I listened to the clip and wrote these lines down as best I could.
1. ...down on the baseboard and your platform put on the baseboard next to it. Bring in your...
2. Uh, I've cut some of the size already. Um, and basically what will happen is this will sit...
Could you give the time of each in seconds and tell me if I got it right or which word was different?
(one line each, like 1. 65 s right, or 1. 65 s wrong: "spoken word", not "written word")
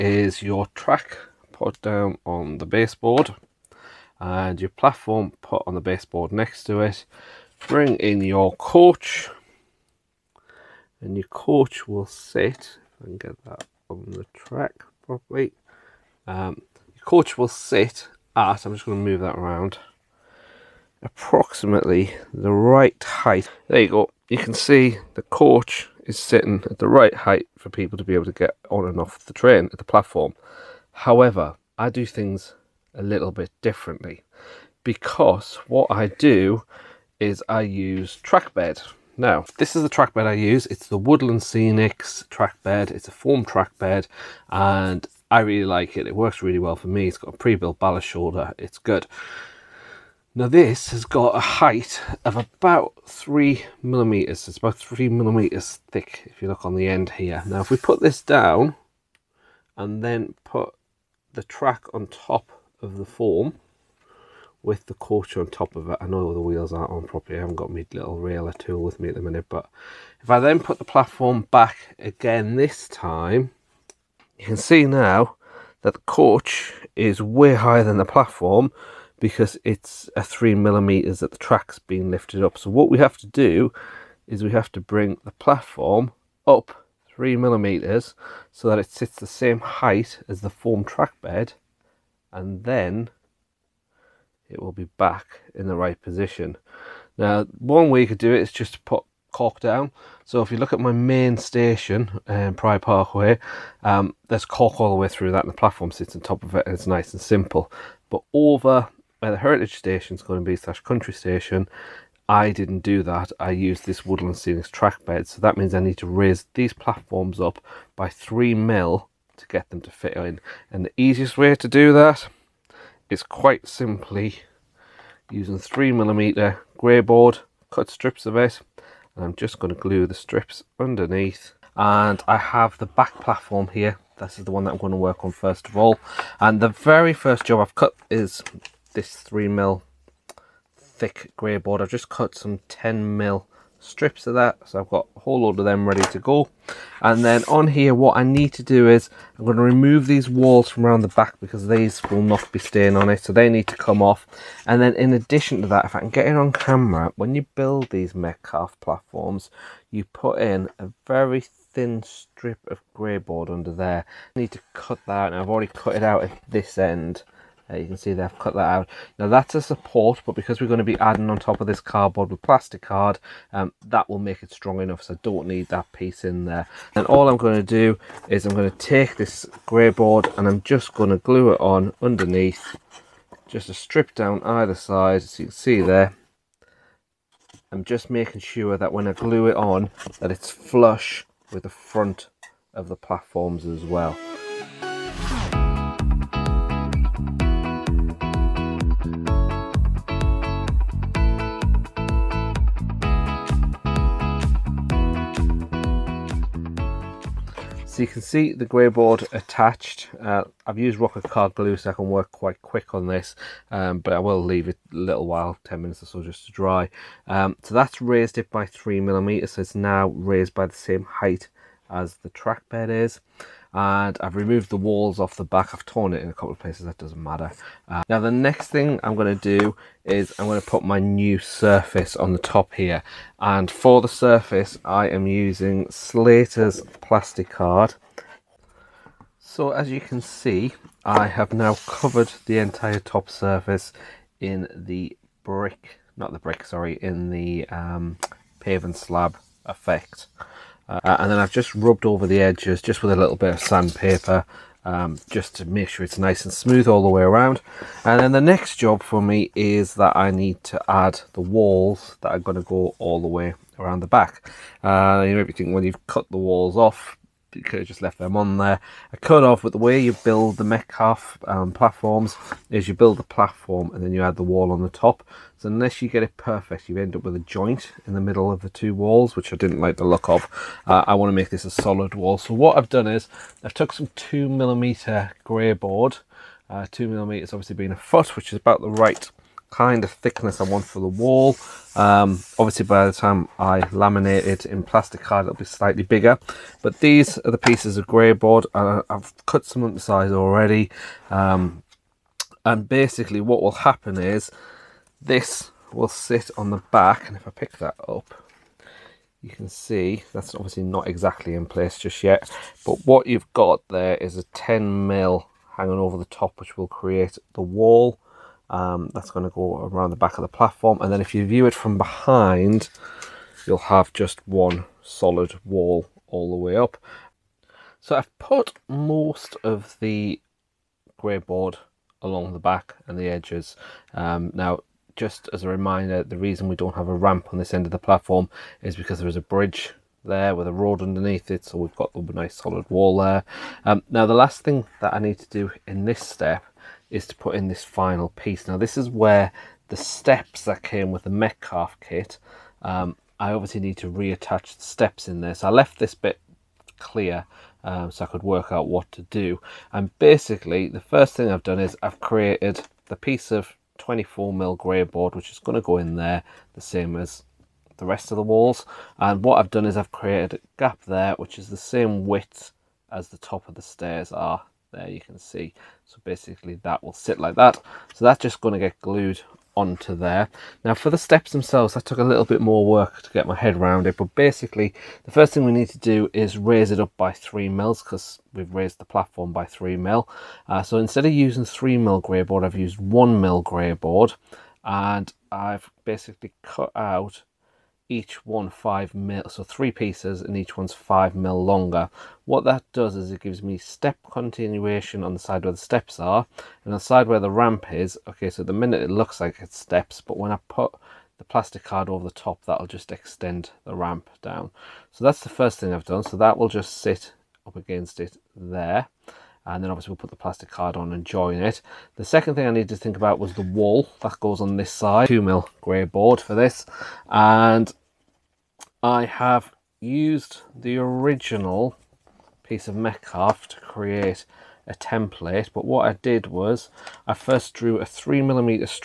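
1. 1 s right
2. 298 s right.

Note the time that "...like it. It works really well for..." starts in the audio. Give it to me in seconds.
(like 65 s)
45 s.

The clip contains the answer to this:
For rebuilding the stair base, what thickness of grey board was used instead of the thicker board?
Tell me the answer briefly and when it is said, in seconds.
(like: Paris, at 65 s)
1mm, at 392 s.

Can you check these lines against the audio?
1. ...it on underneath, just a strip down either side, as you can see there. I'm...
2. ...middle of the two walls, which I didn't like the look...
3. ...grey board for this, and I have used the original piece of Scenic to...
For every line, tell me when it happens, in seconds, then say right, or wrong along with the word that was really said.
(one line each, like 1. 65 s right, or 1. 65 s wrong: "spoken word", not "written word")
1. 181 s right
2. 278 s right
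3. 425 s wrong: "Metcalfe", not "Scenic".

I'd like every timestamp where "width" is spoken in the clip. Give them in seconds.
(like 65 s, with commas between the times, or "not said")
372 s.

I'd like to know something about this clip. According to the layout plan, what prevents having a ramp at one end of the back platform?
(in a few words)
a bridge.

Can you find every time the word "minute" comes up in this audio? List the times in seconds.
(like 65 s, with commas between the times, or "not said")
69 s, 215 s, 408 s.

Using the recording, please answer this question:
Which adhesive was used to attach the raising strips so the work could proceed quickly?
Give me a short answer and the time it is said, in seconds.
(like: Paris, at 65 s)
Roket card glue, at 210 s.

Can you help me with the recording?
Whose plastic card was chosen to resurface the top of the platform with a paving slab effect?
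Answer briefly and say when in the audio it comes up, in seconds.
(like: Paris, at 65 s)
Slater's, at 235 s.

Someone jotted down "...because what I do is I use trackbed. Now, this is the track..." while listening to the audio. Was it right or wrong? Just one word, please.
right.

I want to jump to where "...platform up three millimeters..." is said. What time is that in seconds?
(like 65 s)
85 s.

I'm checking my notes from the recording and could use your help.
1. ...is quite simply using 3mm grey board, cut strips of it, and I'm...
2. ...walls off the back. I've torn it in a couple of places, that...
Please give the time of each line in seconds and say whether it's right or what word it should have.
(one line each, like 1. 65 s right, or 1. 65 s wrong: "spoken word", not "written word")
1. 123 s right
2. 224 s right.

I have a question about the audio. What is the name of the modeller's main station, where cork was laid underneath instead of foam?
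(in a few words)
Pride Parkway.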